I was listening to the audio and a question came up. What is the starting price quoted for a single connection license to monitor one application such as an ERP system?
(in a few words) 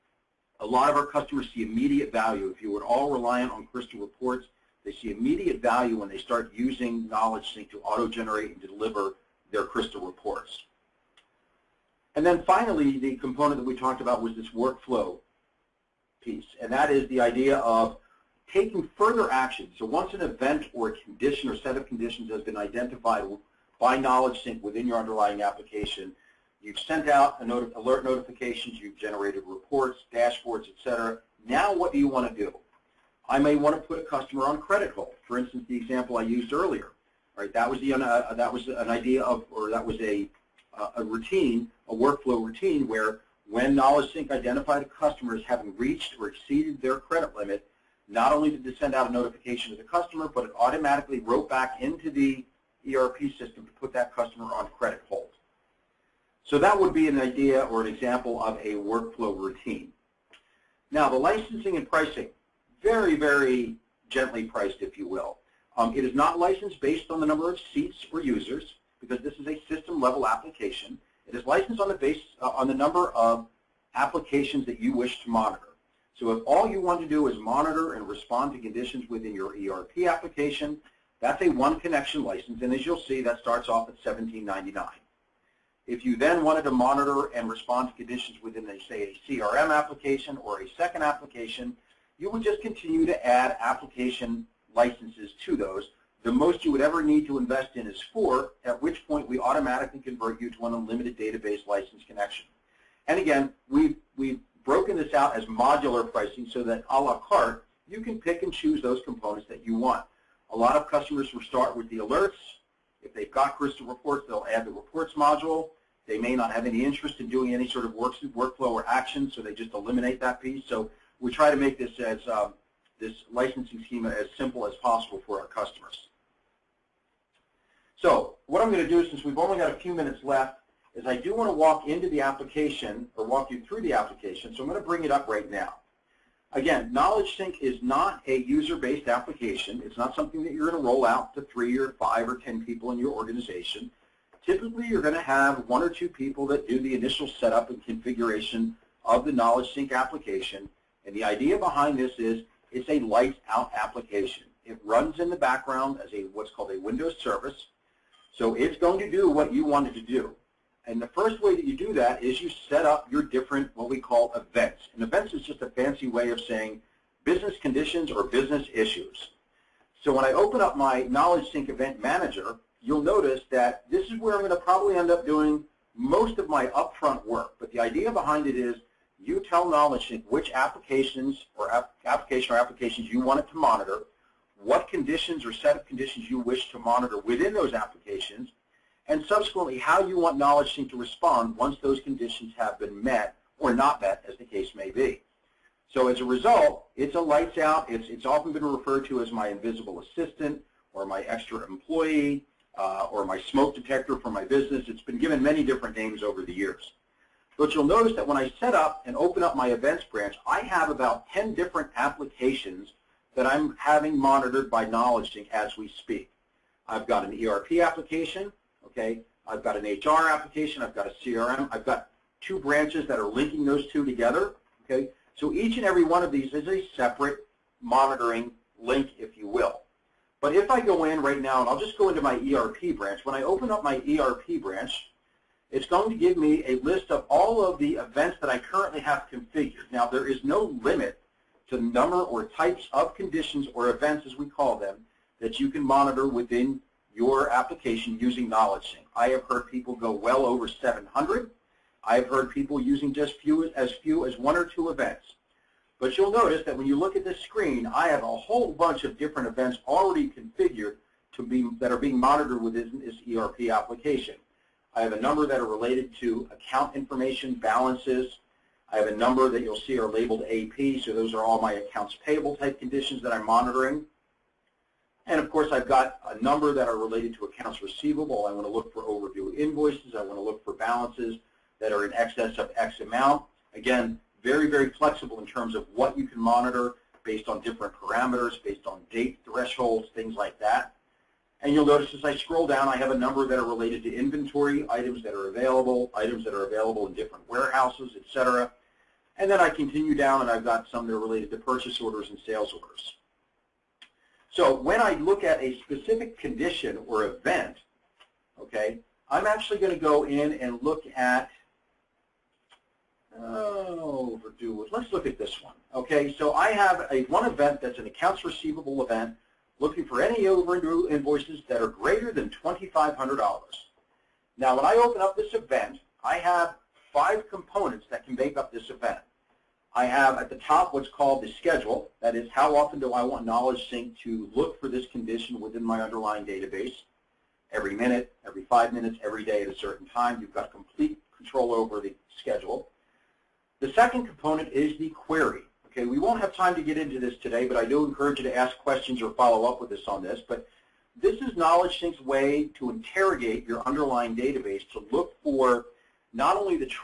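$17.99.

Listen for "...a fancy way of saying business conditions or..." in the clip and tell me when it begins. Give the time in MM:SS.
02:45.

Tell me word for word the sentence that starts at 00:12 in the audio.
And then finally, the component that we talked about was this workflow piece, and that is the idea of taking further action.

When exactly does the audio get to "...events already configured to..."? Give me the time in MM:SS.
04:19.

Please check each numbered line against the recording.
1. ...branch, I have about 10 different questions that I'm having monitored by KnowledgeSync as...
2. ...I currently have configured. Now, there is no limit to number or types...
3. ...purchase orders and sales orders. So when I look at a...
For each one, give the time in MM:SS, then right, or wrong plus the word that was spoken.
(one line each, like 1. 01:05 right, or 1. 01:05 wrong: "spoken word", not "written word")
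1. 03:30 wrong: "applications", not "questions"
2. 03:58 right
3. 05:01 right.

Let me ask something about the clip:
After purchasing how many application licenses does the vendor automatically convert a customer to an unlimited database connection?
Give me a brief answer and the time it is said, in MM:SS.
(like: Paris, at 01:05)
4, at 01:38.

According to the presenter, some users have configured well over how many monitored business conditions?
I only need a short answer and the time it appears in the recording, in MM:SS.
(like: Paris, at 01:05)
700, at 04:10.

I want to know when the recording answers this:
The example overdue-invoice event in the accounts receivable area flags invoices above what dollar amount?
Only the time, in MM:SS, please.
05:22.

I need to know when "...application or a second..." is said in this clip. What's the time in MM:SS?
01:29.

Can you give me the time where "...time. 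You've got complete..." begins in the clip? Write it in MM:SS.
05:40.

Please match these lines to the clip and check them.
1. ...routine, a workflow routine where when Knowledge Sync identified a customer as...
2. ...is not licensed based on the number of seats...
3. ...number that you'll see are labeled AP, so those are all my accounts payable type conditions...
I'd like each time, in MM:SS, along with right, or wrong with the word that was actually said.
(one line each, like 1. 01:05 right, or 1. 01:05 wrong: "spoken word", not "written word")
1. 00:41 right
2. 01:06 right
3. 04:29 right.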